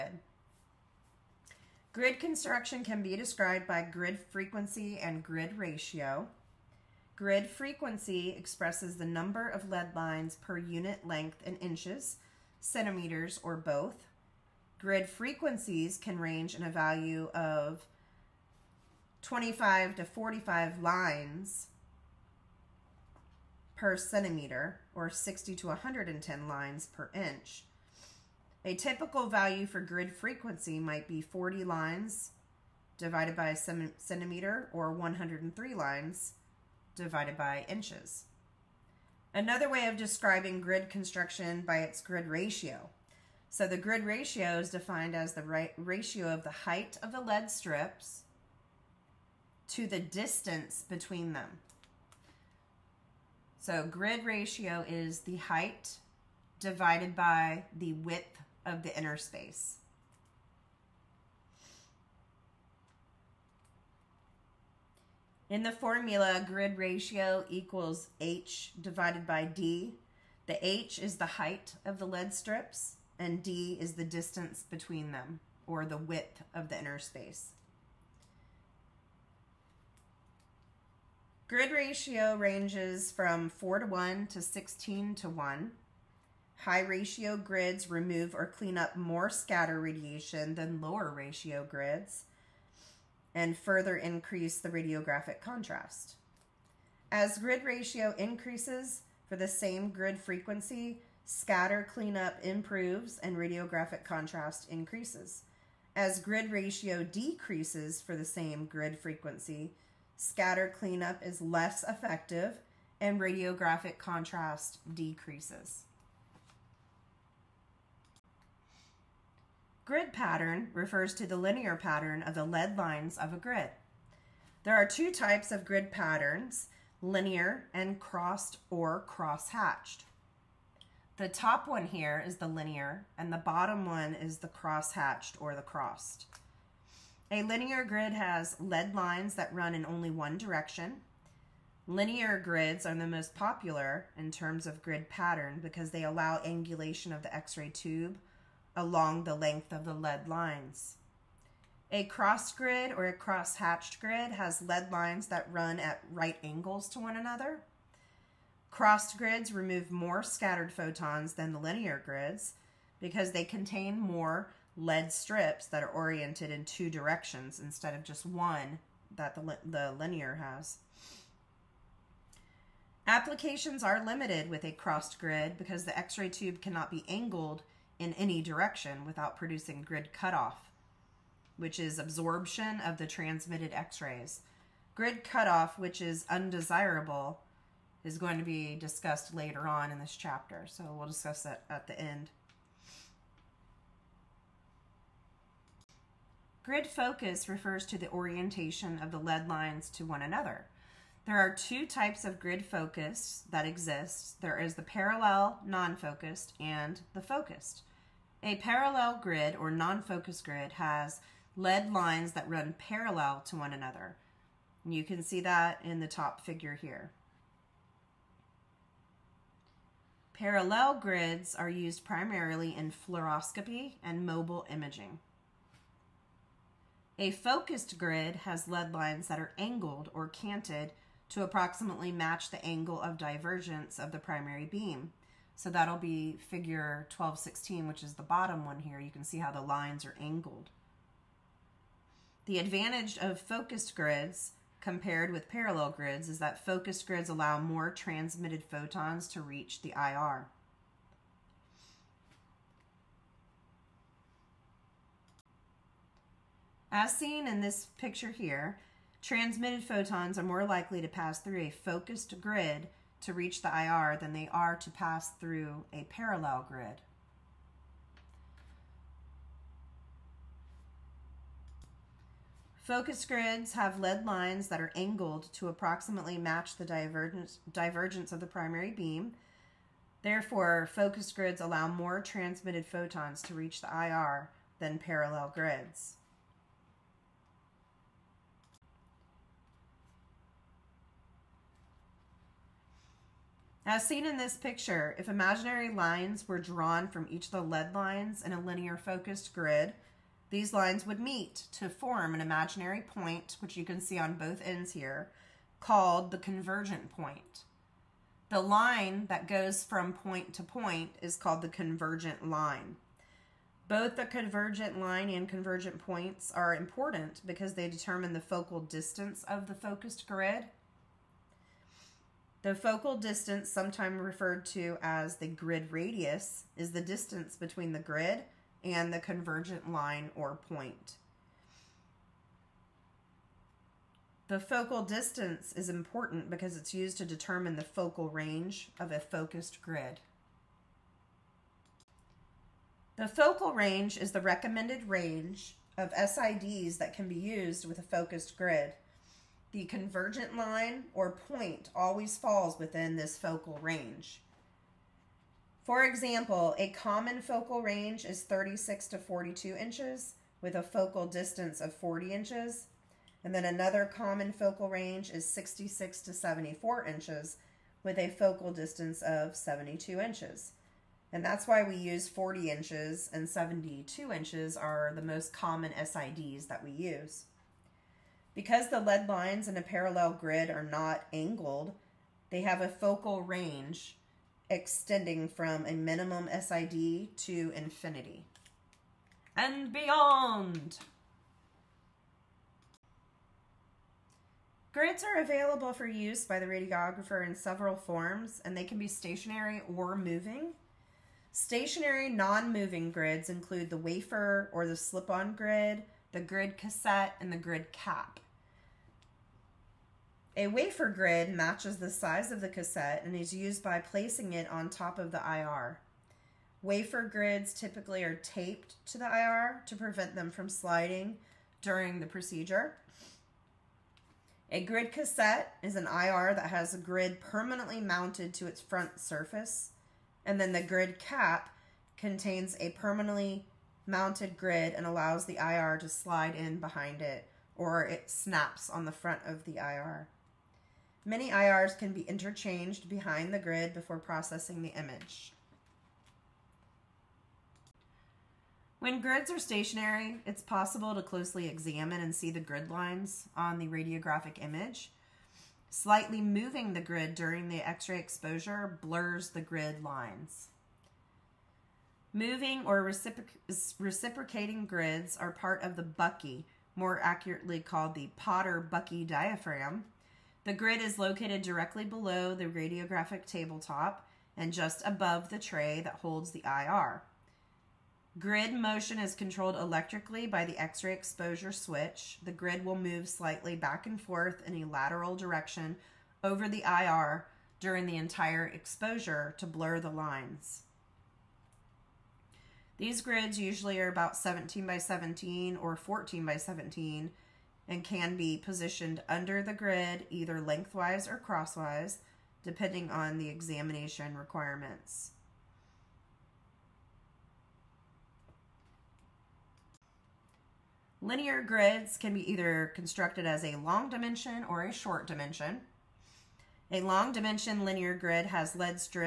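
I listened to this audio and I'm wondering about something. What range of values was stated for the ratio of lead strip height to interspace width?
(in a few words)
4 to 1 to 16 to 1.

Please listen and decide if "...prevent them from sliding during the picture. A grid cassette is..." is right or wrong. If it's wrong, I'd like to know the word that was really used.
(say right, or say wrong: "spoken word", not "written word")
wrong: "procedure", not "picture".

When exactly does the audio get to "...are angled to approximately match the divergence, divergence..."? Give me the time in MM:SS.
04:34.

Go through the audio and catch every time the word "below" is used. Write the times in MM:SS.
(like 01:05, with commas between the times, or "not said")
07:52.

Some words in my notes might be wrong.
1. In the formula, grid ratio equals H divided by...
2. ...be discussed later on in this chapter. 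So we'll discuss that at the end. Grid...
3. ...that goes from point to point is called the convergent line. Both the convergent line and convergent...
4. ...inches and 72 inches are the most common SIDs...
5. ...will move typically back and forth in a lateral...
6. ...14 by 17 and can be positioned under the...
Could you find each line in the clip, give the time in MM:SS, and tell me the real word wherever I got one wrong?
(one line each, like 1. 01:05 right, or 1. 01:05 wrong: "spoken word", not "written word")
1. 01:05 right
2. 03:08 right
3. 05:09 right
4. 06:12 right
5. 08:02 wrong: "slightly", not "typically"
6. 08:15 right.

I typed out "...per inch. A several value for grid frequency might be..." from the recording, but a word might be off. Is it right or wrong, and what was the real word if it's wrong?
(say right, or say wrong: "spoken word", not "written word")
wrong: "typical", not "several".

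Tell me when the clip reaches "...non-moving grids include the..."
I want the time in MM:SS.
06:42.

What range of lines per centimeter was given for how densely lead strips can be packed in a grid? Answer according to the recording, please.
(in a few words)
25 to 45.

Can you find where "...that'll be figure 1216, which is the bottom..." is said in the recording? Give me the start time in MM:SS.
03:55.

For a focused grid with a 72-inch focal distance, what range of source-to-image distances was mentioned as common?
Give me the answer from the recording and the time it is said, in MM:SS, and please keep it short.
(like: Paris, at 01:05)
66 to 74 inches, at 06:05.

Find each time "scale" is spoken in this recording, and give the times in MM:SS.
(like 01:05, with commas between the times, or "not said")
not said.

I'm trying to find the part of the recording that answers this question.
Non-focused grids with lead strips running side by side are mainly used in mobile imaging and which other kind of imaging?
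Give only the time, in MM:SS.
03:42.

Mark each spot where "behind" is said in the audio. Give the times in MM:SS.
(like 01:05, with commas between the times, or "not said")
07:16, 07:23.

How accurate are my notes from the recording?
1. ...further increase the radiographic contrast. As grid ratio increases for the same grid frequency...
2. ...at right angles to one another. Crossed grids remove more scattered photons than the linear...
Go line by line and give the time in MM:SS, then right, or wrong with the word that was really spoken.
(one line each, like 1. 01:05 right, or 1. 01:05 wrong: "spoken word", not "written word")
1. 01:33 right
2. 02:35 right.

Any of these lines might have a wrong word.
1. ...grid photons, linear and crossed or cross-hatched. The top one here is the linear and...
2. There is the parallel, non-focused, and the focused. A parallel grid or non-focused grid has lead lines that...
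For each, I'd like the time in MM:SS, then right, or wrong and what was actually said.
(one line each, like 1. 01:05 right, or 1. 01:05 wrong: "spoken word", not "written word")
1. 02:05 wrong: "patterns", not "photons"
2. 03:24 right.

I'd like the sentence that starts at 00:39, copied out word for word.
Another way of describing grid construction by its grid ratio.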